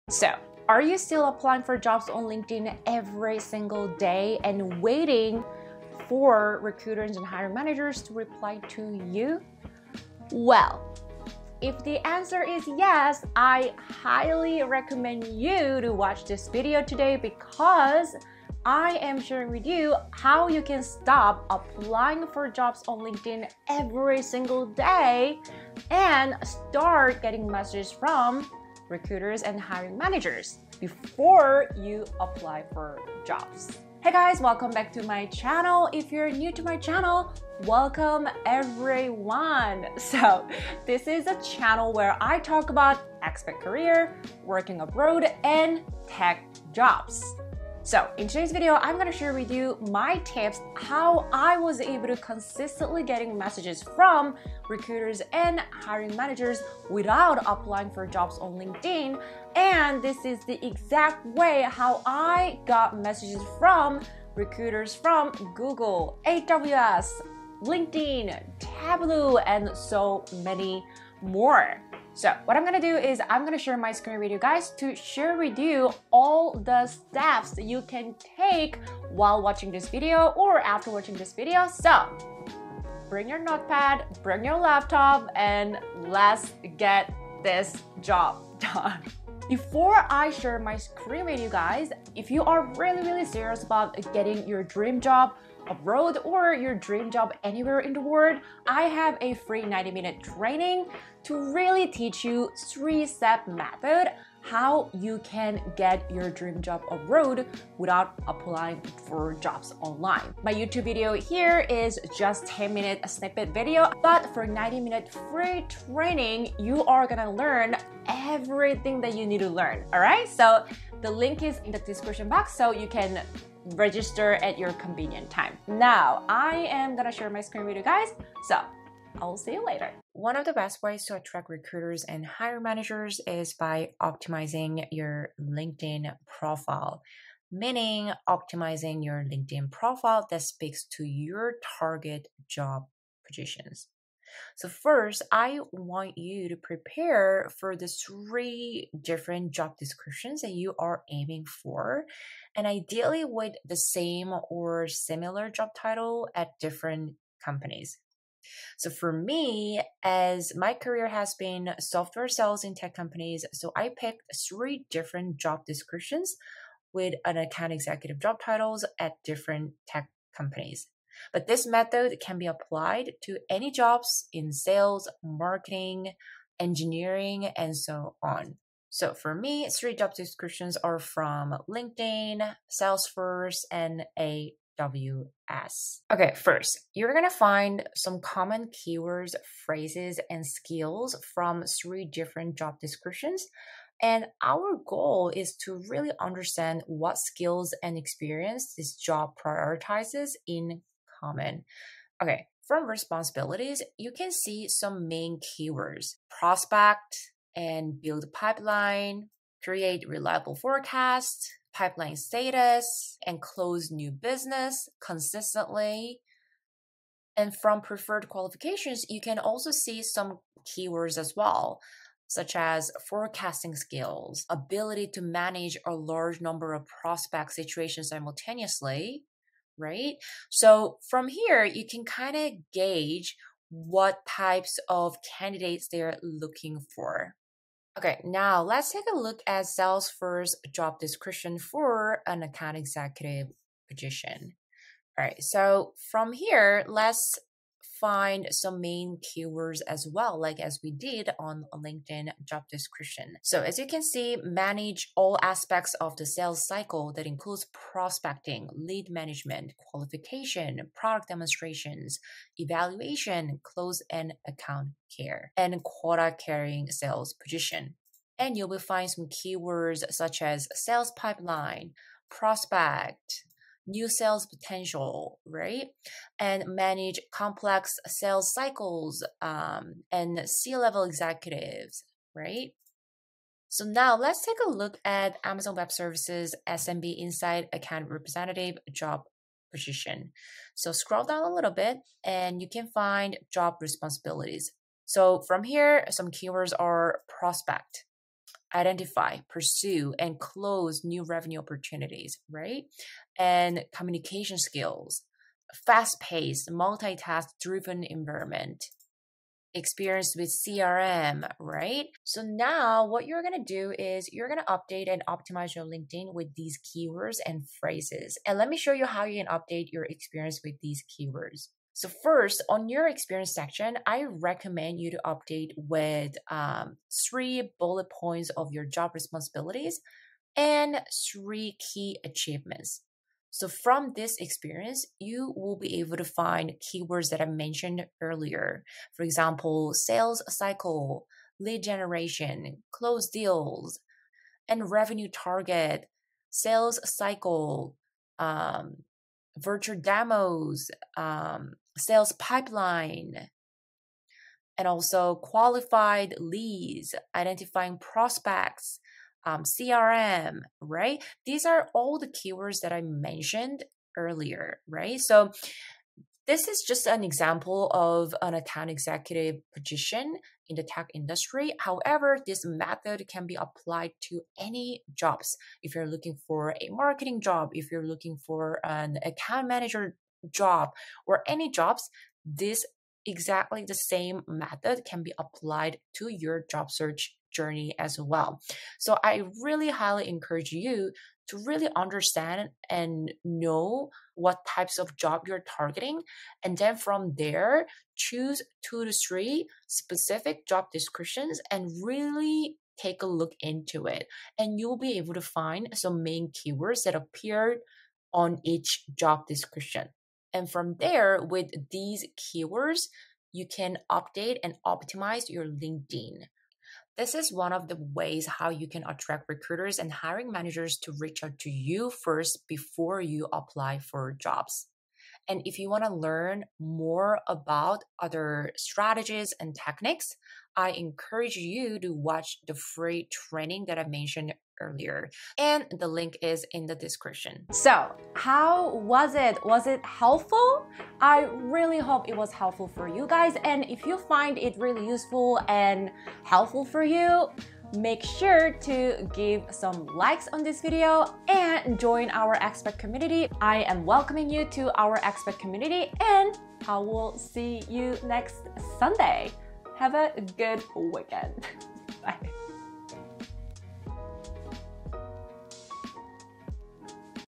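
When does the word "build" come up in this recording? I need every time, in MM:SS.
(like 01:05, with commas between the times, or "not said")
03:28.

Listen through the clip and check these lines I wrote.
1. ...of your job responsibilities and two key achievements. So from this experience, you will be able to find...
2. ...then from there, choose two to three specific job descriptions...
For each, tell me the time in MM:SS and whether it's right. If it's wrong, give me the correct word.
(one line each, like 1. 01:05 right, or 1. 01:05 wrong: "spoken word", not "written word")
1. 05:28 wrong: "three", not "two"
2. 06:36 right.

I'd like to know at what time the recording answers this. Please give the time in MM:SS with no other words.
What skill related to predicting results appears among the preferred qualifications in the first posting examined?
03:43.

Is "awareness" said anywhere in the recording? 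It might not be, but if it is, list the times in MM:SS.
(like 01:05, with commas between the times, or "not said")
not said.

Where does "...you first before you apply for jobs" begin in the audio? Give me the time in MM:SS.
07:01.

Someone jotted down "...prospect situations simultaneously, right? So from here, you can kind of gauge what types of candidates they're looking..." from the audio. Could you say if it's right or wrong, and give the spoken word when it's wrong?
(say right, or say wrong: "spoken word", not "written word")
right.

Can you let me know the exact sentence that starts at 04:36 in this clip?
And manage complex sales cycles um, and C level executives, right?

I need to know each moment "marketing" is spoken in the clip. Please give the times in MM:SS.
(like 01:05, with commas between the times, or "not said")
02:55, 06:16.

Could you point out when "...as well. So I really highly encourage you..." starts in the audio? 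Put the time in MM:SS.
06:27.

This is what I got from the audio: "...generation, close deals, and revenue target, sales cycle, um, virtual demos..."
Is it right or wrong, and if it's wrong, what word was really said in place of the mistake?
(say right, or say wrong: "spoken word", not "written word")
right.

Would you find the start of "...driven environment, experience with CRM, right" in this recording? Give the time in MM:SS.
05:07.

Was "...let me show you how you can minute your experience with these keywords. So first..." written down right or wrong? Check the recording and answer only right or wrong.
wrong.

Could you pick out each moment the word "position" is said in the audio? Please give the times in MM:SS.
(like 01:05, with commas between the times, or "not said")
02:23, 04:03, 04:27, 04:49, 06:09.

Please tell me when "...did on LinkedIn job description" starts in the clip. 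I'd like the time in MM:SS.
04:10.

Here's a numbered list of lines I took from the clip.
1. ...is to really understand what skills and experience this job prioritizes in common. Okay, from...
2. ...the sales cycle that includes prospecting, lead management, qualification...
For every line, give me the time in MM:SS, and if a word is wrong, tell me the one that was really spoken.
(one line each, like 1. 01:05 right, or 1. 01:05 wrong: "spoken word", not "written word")
1. 03:15 right
2. 04:16 right.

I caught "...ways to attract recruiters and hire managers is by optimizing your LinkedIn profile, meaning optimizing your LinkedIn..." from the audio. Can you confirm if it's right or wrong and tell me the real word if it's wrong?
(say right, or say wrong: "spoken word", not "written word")
right.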